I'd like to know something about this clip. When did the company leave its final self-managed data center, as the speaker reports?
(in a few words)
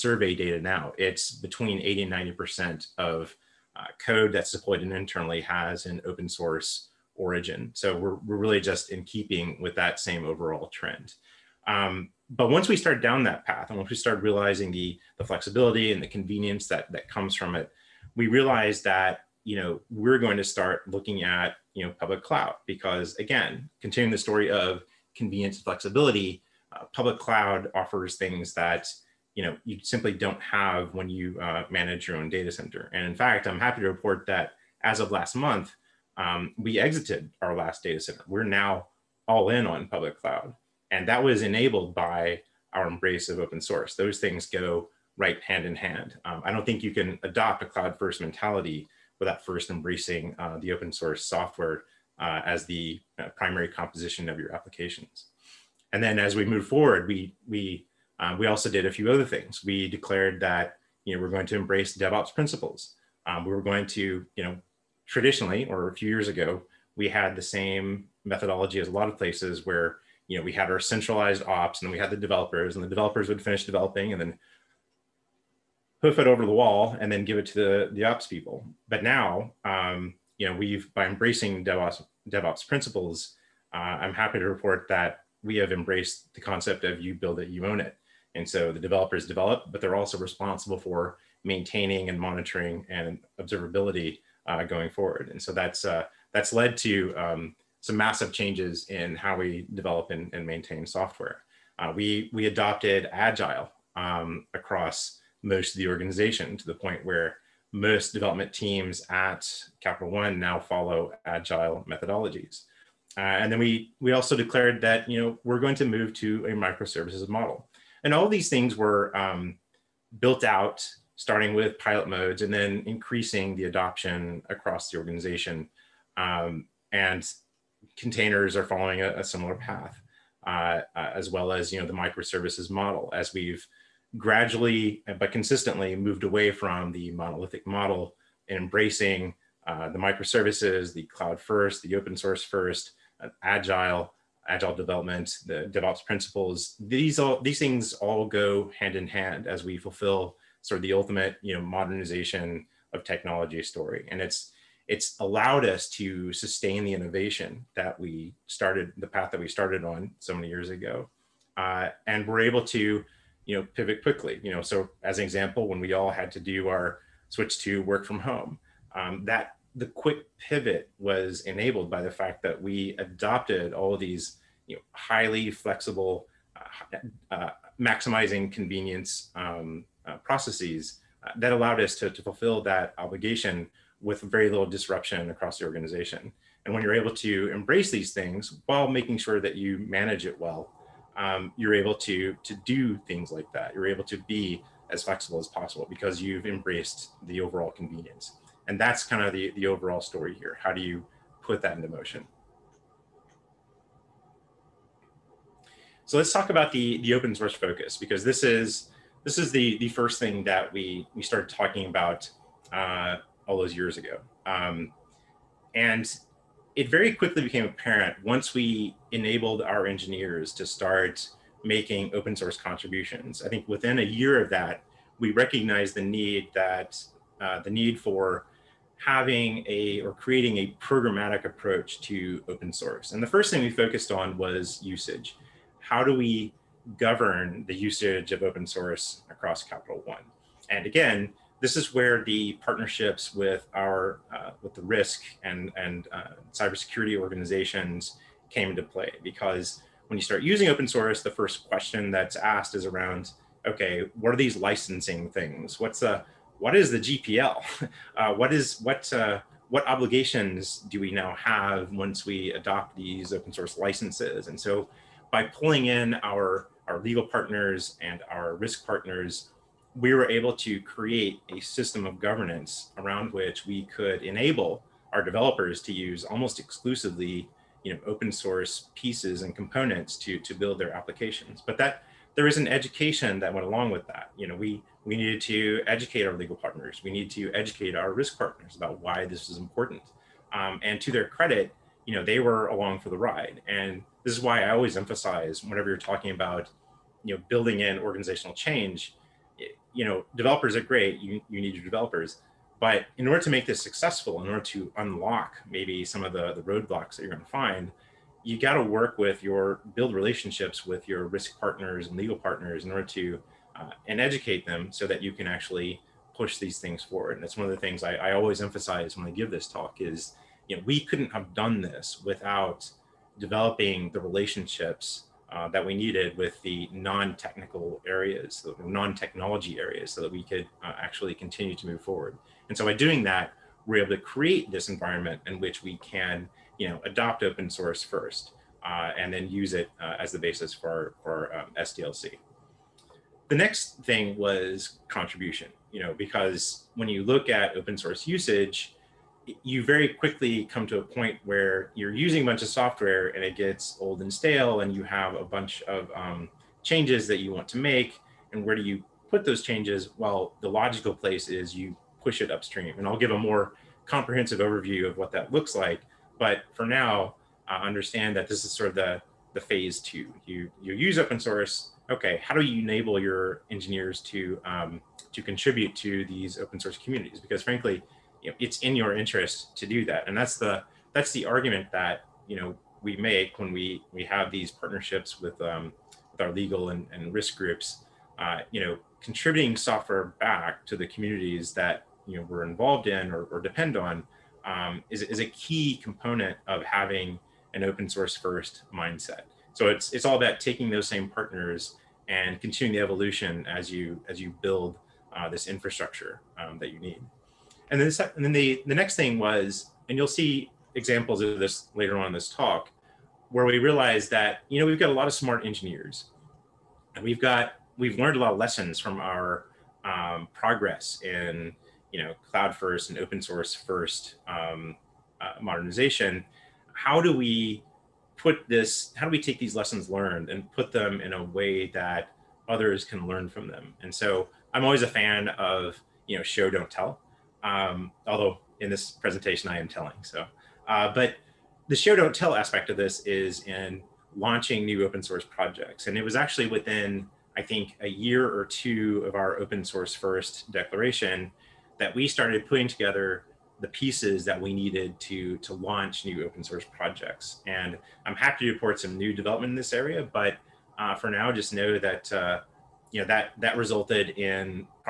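last month.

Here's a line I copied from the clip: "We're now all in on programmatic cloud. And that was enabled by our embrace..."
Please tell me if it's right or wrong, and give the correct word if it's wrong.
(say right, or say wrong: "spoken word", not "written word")
wrong: "public", not "programmatic".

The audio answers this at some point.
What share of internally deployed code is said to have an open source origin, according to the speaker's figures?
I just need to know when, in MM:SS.
00:01.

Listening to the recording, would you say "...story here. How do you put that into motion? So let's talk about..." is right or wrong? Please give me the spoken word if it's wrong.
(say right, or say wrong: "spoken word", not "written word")
right.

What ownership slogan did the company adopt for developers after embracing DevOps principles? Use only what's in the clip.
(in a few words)
you build it, you own it.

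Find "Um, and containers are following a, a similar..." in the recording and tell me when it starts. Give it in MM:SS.
02:06.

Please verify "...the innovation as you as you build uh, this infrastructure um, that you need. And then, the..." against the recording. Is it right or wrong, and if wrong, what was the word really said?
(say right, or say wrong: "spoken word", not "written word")
wrong: "evolution", not "innovation".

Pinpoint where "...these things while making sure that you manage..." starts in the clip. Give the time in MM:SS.
03:07.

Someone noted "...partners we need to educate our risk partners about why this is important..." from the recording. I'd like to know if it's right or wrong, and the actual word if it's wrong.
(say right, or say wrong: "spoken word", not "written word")
right.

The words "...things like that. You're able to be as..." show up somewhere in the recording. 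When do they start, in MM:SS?
03:13.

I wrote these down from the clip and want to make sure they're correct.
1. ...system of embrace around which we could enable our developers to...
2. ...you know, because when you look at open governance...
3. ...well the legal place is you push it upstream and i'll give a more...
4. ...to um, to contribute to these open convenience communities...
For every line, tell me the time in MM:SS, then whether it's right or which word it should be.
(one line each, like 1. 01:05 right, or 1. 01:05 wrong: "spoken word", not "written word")
1. 04:31 wrong: "governance", not "embrace"
2. 05:45 wrong: "source", not "governance"
3. 06:00 wrong: "logical", not "legal"
4. 06:14 wrong: "source", not "convenience".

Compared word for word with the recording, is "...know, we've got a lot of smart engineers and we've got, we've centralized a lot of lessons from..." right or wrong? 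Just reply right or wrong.
wrong.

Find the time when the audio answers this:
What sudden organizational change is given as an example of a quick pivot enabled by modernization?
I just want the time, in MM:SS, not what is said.
02:47.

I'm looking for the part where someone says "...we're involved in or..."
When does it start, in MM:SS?
06:32.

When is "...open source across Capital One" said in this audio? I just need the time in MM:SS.
03:58.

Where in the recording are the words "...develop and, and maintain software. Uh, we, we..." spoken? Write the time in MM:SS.
01:39.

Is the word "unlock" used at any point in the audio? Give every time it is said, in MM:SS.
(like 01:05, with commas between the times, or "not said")
05:04.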